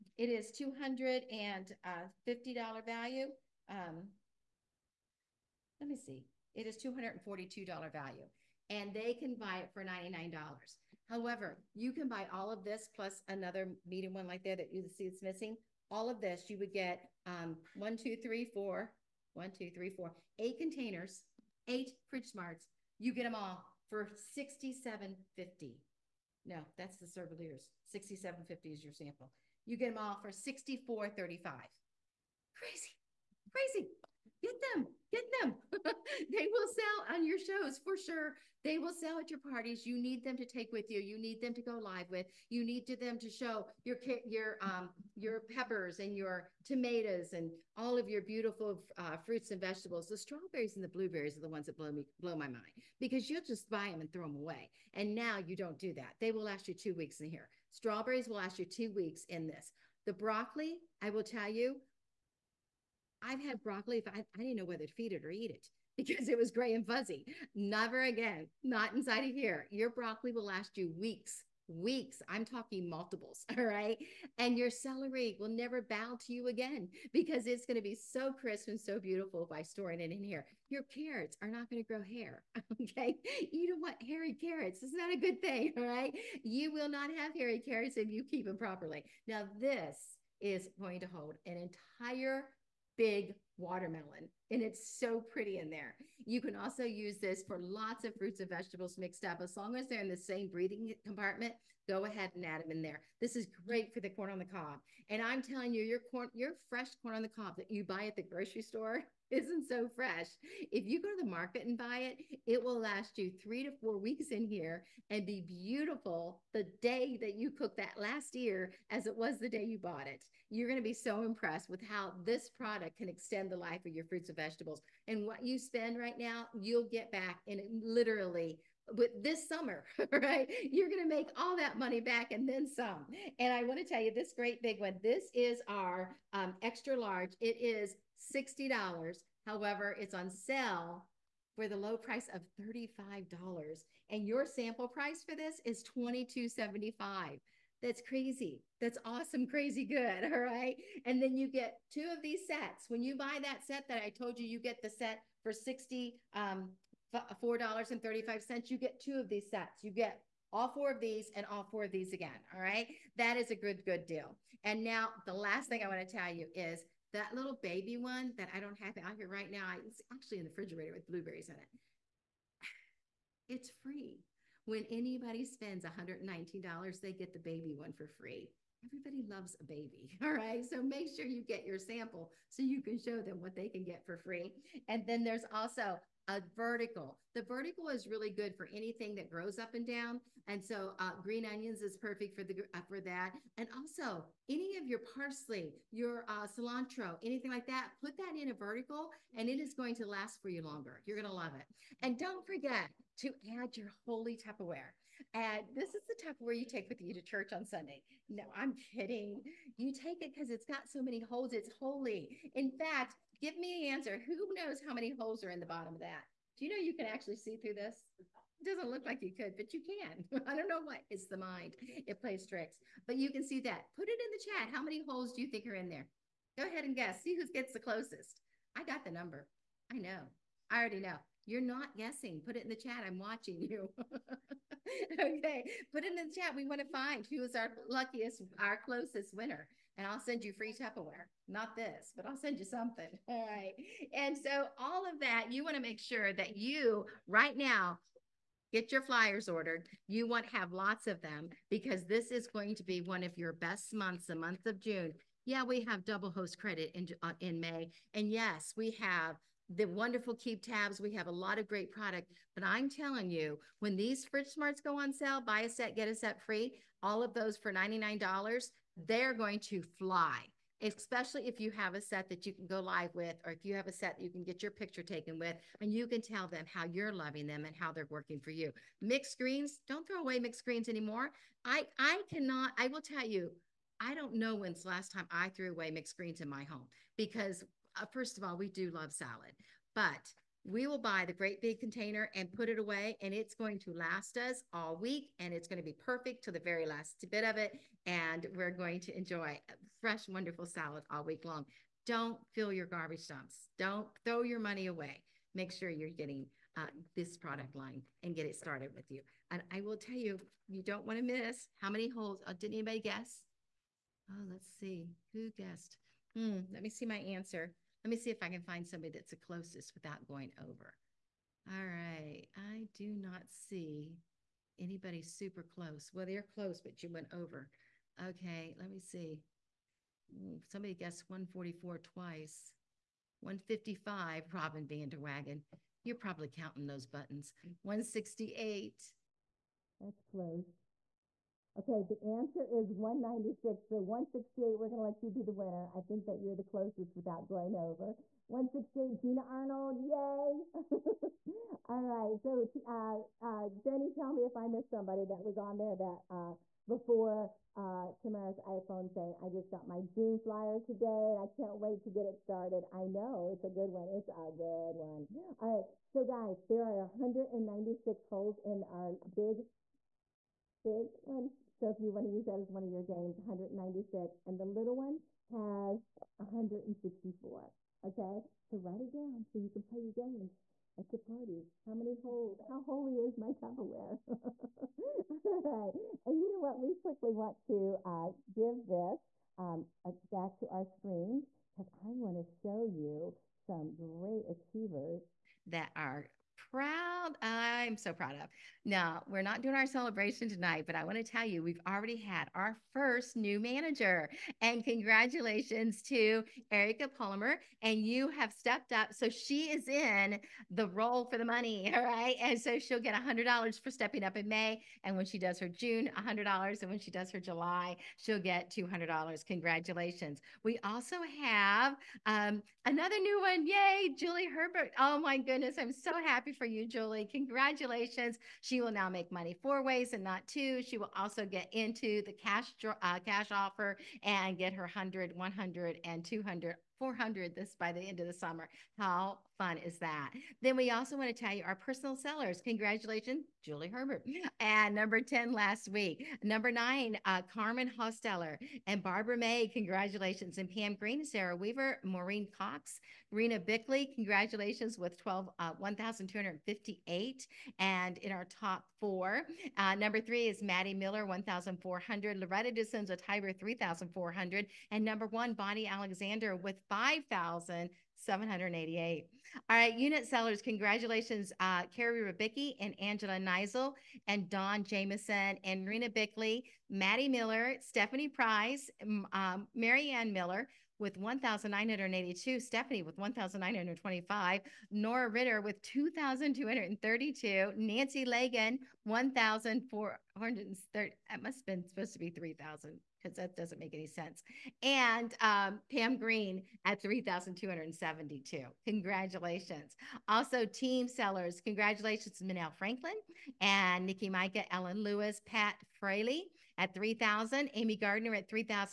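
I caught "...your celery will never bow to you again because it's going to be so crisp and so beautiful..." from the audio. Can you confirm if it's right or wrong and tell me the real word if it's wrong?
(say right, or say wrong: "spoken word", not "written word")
right.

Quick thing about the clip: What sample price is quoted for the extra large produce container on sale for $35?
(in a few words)
$22.75.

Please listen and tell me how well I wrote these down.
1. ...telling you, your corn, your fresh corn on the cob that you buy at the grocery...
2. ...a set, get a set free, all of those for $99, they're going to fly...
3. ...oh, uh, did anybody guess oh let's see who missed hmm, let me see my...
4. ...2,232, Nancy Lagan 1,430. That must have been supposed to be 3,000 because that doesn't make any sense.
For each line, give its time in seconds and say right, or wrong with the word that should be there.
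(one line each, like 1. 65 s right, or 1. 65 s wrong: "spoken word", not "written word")
1. 105 s right
2. 265 s right
3. 312 s wrong: "guessed", not "missed"
4. 485 s right.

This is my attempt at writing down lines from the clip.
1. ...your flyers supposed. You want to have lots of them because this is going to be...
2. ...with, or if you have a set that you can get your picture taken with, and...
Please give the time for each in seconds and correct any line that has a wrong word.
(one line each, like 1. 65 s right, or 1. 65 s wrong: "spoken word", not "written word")
1. 248 s wrong: "ordered", not "supposed"
2. 273 s right.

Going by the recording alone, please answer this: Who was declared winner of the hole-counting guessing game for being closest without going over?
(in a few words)
Gina Arnold.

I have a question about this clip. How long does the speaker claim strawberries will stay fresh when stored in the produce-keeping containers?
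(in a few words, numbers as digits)
2 weeks.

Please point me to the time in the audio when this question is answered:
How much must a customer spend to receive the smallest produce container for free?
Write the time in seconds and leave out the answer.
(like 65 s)
175 s.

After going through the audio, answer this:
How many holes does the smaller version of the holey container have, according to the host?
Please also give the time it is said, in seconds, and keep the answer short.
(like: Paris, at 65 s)
164, at 374 s.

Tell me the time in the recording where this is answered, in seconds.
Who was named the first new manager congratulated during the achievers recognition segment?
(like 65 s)
406 s.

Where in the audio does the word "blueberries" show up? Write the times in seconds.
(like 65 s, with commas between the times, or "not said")
50 s, 171 s.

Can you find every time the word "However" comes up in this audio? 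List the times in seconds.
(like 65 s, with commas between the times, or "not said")
11 s, 139 s.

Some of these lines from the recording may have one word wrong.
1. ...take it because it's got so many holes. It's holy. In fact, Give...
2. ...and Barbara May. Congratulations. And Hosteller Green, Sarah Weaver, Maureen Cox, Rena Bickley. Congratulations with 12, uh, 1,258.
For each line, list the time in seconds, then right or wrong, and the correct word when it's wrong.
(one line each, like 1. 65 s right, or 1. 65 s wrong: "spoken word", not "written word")
1. 209 s right
2. 448 s wrong: "Pam", not "Hosteller".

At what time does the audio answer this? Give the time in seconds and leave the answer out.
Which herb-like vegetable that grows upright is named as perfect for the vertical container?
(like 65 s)
191 s.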